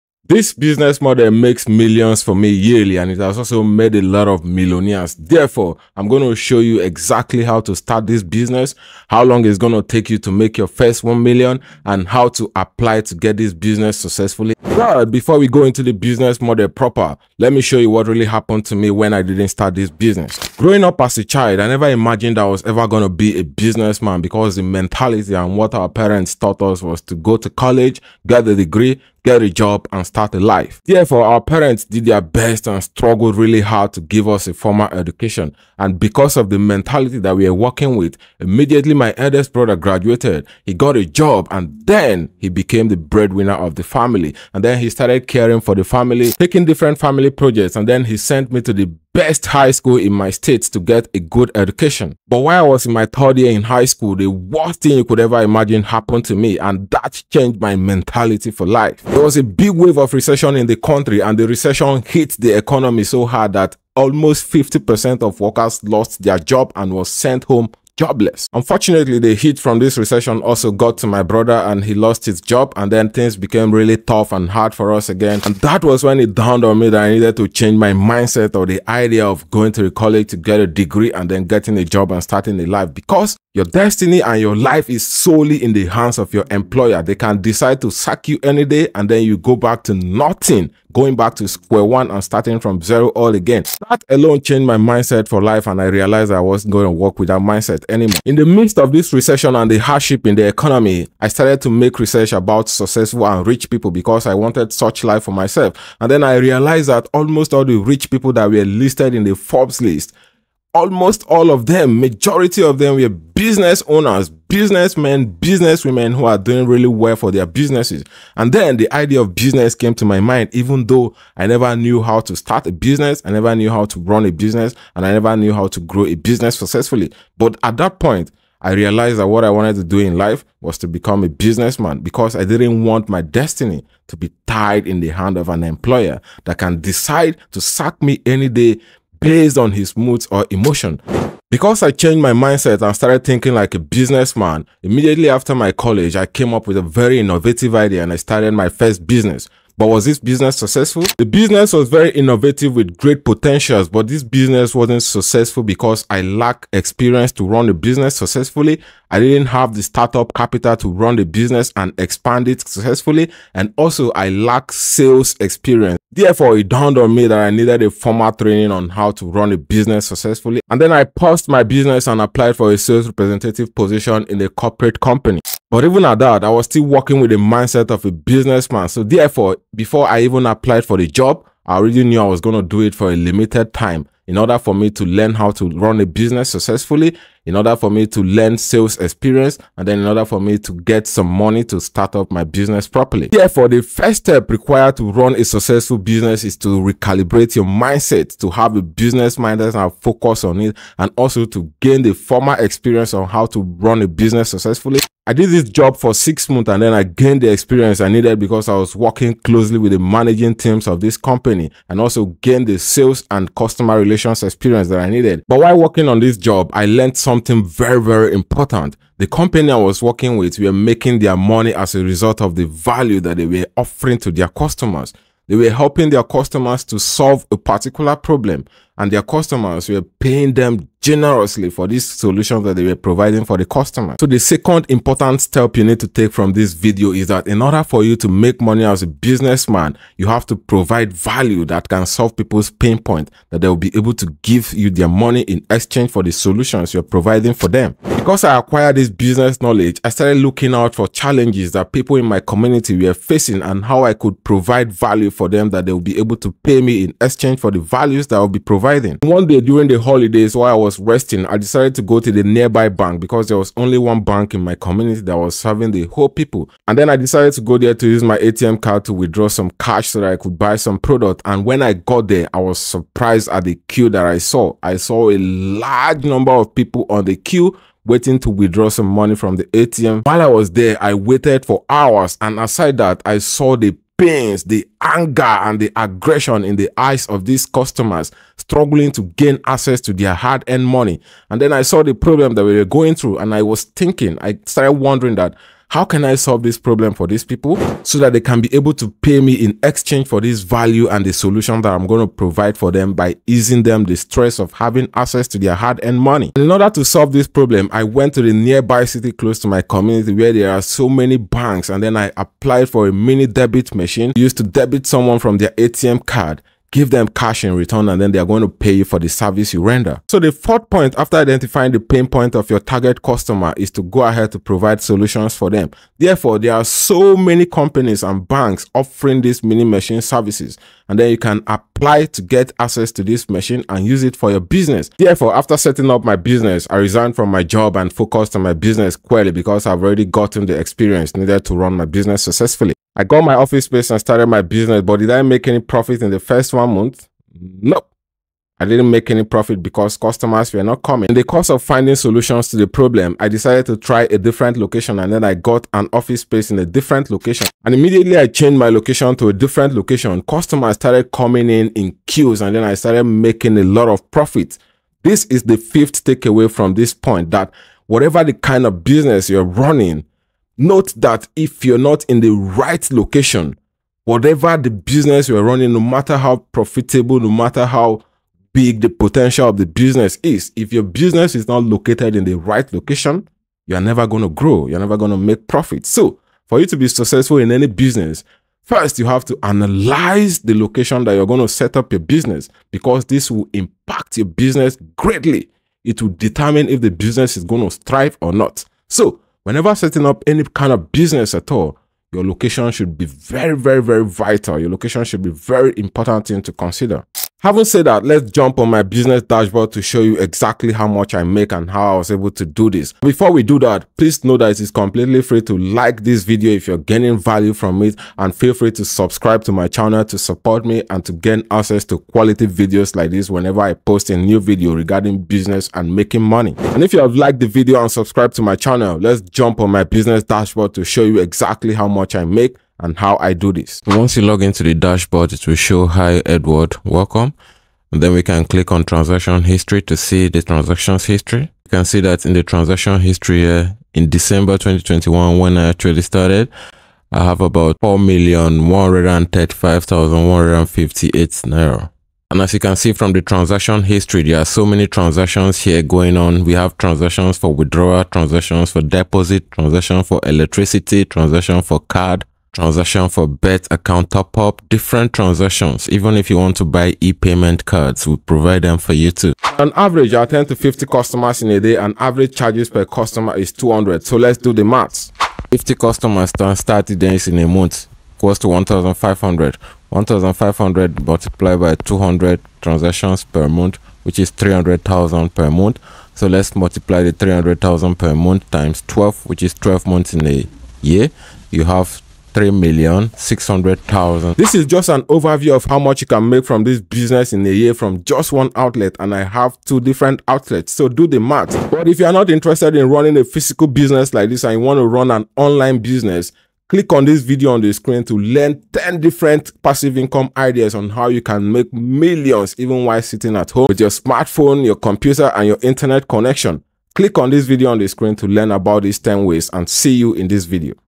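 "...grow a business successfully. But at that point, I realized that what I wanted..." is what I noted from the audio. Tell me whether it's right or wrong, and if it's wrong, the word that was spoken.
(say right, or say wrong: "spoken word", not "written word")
right.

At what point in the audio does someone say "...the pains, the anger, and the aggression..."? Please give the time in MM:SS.
04:43.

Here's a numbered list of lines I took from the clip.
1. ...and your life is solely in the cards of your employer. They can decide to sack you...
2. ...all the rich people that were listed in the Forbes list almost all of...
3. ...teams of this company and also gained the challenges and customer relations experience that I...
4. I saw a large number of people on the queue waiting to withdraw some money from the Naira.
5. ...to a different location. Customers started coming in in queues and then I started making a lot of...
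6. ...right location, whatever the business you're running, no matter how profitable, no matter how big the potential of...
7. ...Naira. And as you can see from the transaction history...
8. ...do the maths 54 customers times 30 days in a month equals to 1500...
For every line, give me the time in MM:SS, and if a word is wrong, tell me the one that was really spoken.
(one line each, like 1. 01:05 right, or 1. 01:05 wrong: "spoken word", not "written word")
1. 01:24 wrong: "hands", not "cards"
2. 01:47 right
3. 03:30 wrong: "sales", not "challenges"
4. 04:34 wrong: "ATM", not "Naira"
5. 05:59 right
6. 06:12 right
7. 07:31 right
8. 07:54 wrong: "50", not "54".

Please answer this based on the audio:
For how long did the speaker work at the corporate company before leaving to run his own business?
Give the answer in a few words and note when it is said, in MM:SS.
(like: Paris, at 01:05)
6 months, at 03:26.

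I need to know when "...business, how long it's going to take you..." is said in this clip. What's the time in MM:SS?
00:08.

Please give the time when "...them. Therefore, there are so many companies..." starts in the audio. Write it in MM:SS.
05:25.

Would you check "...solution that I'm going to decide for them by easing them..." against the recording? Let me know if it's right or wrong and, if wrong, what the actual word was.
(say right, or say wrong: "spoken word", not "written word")
wrong: "provide", not "decide".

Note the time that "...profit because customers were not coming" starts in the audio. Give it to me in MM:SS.
05:49.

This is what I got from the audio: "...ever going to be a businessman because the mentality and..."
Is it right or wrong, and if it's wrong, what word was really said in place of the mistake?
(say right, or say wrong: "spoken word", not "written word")
right.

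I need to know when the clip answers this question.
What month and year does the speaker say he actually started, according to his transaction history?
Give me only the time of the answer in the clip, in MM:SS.
07:24.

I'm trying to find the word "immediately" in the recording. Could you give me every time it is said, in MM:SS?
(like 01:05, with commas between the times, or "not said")
00:38, 02:24, 05:57.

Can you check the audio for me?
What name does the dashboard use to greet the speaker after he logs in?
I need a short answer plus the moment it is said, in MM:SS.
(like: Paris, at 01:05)
Edward, at 07:16.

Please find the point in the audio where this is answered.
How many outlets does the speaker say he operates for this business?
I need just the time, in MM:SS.
08:19.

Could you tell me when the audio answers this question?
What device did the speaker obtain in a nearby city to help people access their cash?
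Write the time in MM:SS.
05:13.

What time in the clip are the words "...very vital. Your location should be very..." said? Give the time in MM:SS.
06:44.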